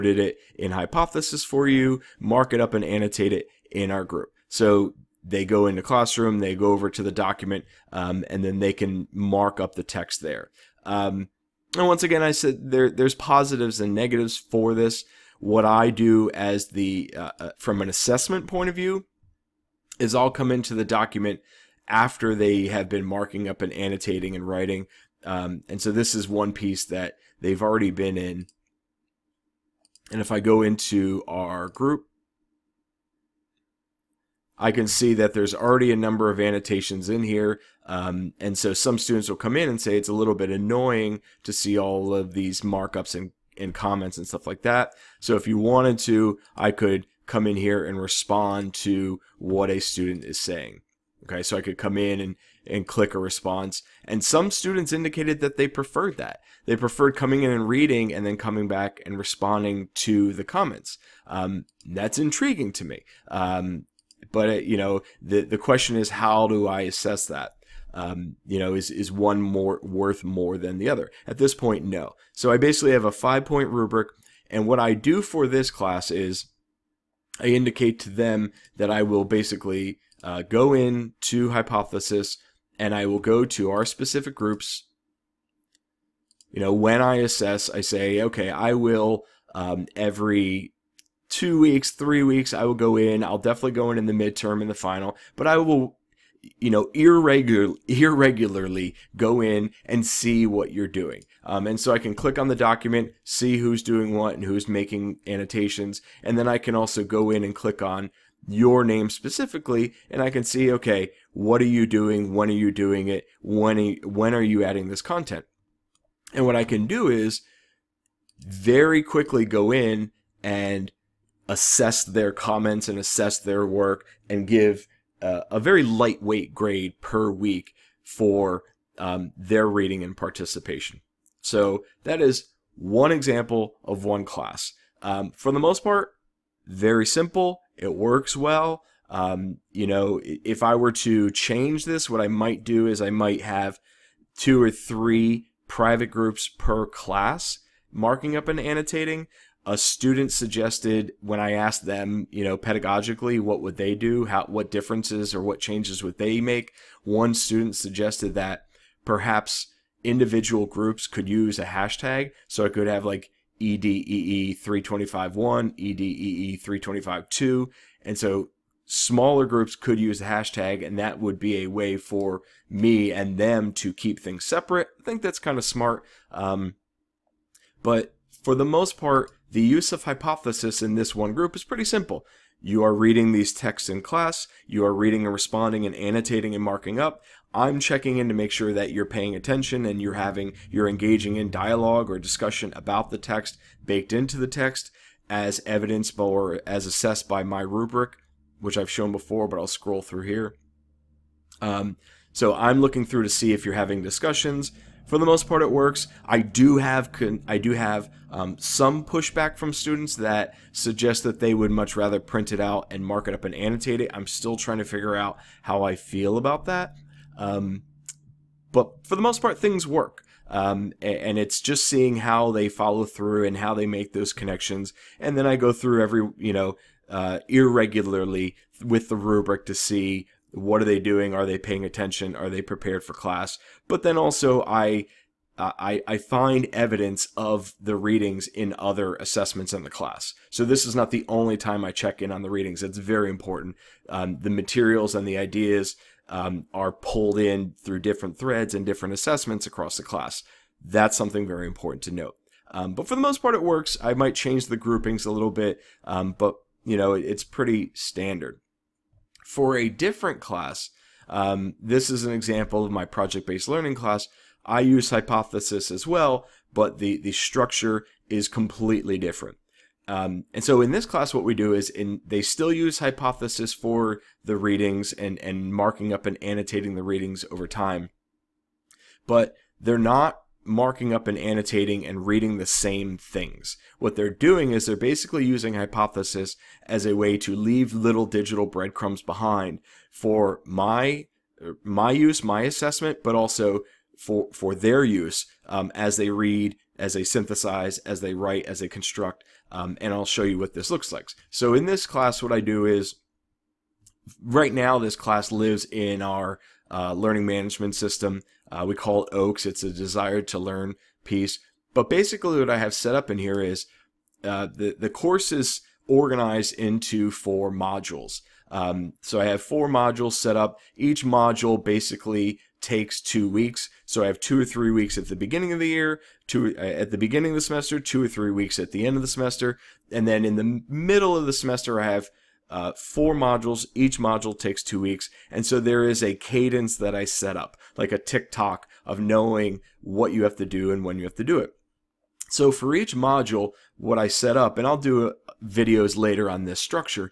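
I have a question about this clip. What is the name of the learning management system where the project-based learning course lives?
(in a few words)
Oaks.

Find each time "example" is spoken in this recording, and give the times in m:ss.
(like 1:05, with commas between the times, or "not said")
2:13, 4:22.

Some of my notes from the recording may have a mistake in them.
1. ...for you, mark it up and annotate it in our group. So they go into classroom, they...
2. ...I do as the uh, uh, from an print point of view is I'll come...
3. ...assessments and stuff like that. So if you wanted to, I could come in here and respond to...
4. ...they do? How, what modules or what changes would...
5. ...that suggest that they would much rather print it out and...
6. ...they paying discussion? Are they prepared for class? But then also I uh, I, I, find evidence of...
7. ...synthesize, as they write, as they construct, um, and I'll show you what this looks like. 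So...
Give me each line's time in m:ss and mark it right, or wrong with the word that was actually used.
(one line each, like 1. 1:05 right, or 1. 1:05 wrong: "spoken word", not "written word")
1. 0:01 right
2. 0:15 wrong: "assessment", not "print"
3. 0:43 wrong: "comments", not "assessments"
4. 2:33 wrong: "differences", not "modules"
5. 3:30 right
6. 3:51 wrong: "attention", not "discussion"
7. 4:57 right.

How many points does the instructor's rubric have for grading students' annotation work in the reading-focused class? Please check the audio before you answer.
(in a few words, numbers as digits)
5.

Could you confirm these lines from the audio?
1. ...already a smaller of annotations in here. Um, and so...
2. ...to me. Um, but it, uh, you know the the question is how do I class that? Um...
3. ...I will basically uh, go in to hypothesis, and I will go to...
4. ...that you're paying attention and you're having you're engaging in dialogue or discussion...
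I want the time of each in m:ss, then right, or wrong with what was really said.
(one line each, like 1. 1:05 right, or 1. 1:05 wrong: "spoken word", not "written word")
1. 0:35 wrong: "number", not "smaller"
2. 1:02 wrong: "assess", not "class"
3. 1:18 right
4. 3:08 right.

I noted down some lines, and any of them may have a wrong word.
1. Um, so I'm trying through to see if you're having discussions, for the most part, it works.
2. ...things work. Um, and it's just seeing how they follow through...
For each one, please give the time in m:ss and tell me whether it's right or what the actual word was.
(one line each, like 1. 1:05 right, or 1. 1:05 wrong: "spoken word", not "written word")
1. 3:21 wrong: "looking", not "trying"
2. 3:39 right.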